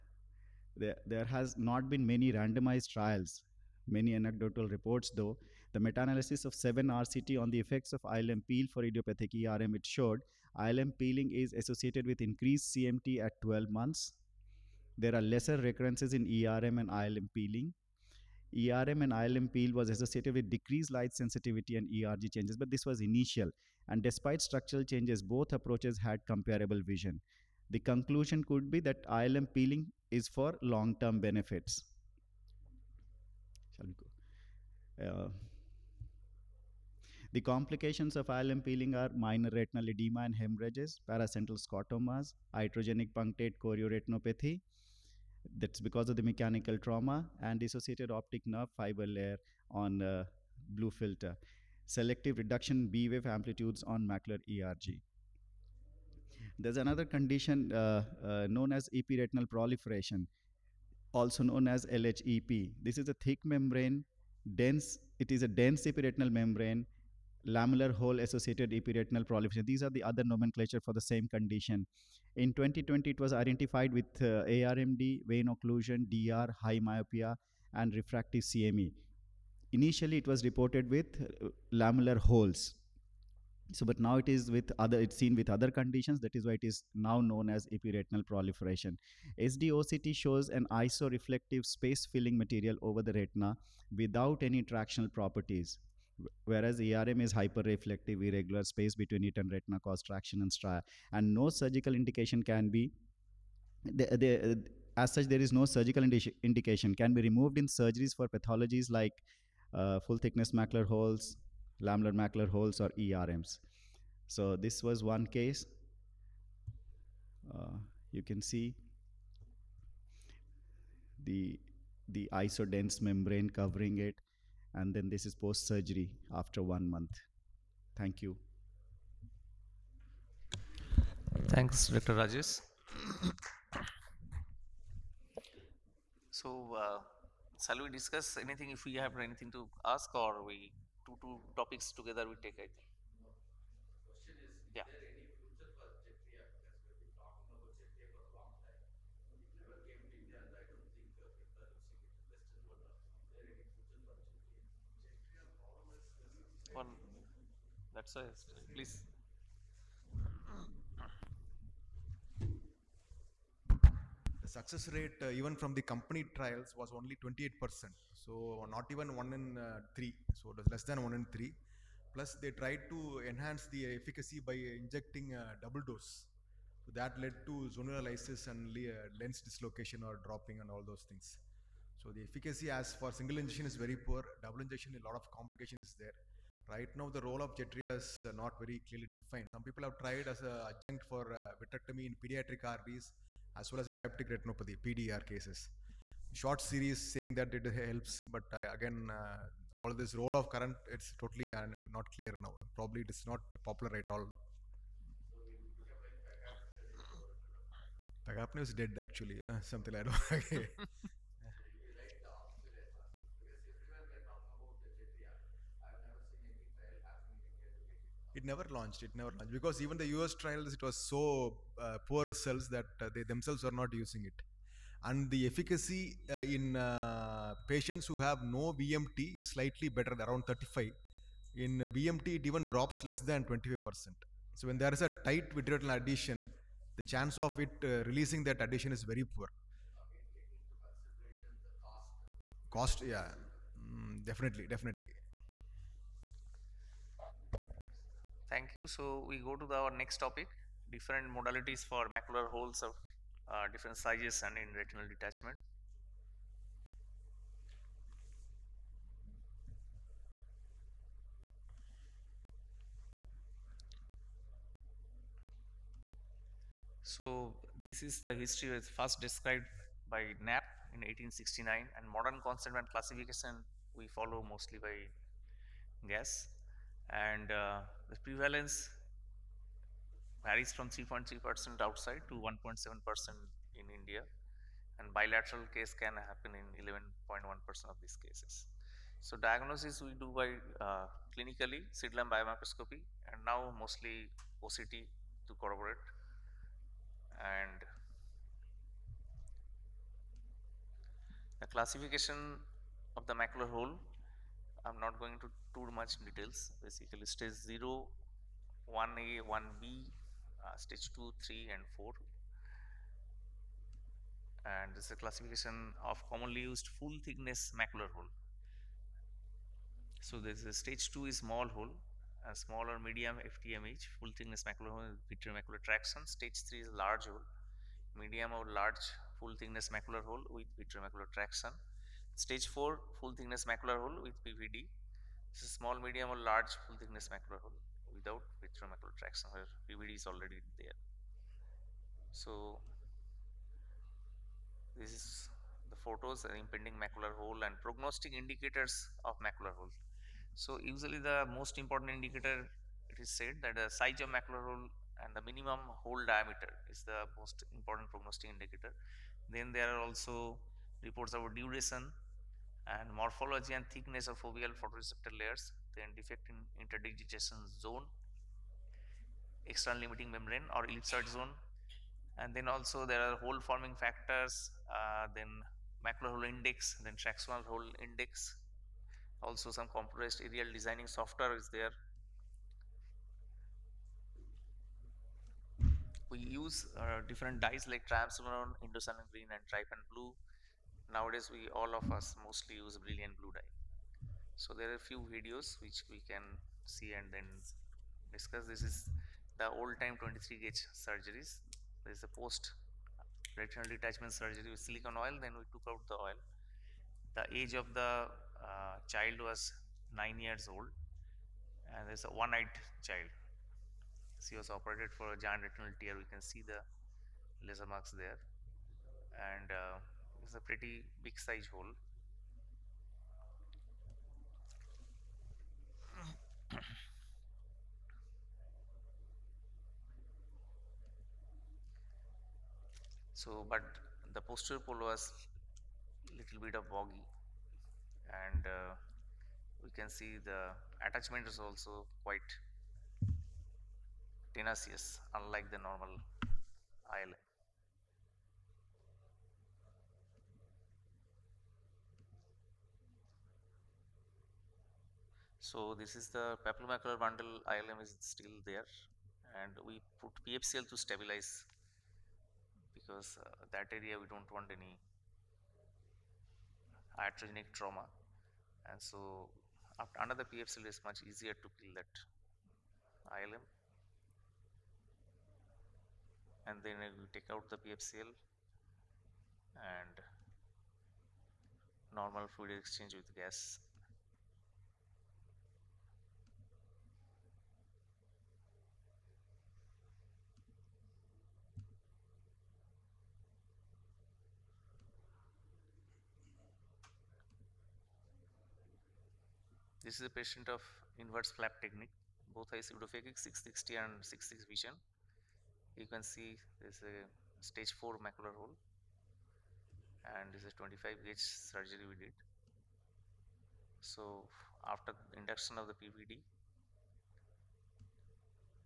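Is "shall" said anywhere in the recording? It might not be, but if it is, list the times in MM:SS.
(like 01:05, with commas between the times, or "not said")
00:33, 02:17.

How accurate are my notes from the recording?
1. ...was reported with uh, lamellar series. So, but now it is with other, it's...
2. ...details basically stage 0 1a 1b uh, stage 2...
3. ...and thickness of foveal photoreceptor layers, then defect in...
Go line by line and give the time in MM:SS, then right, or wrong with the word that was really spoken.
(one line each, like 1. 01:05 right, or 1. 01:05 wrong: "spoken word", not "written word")
1. 01:20 wrong: "holes", not "series"
2. 05:06 right
3. 06:03 right.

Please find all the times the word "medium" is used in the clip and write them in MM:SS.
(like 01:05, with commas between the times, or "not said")
05:22, 05:28, 05:35.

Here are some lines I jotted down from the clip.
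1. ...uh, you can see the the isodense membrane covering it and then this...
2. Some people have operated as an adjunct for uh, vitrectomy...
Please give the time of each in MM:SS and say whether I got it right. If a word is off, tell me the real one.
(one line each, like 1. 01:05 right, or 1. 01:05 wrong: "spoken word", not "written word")
1. 01:57 right
2. 03:09 wrong: "tried", not "operated".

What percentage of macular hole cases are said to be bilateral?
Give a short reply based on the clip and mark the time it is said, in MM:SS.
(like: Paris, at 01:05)
11.1%, at 04:46.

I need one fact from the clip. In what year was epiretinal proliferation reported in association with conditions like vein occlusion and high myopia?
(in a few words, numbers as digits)
2020.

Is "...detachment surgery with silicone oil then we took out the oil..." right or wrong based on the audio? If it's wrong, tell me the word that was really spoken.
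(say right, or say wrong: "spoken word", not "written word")
right.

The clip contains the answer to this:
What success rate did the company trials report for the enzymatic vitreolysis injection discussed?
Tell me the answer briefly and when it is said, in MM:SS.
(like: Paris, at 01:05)
28%, at 02:47.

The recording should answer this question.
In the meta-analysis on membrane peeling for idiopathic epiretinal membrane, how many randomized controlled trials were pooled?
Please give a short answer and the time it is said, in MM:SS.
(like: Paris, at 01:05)
7, at 00:06.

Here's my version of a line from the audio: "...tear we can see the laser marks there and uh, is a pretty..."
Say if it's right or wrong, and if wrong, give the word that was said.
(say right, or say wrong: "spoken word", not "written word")
right.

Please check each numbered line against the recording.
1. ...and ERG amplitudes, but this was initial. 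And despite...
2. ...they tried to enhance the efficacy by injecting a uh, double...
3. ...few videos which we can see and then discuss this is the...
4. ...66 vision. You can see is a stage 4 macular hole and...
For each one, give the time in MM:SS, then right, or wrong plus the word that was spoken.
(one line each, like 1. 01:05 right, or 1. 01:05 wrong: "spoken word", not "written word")
1. 00:21 wrong: "changes", not "amplitudes"
2. 02:52 right
3. 06:35 right
4. 08:24 right.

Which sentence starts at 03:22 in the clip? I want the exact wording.
Probably it is not popular at all Pagapno is dead actually, uh, something like that.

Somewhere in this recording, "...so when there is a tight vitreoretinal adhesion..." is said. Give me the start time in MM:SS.
03:54.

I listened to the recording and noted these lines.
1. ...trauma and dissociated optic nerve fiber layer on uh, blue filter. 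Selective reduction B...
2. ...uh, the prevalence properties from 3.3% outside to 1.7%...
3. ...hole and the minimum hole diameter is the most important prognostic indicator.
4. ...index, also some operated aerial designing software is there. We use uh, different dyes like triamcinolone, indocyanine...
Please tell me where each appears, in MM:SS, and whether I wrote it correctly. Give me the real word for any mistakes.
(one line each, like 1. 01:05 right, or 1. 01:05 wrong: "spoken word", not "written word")
1. 00:46 right
2. 04:37 wrong: "varies", not "properties"
3. 05:54 right
4. 06:18 wrong: "compressed", not "operated".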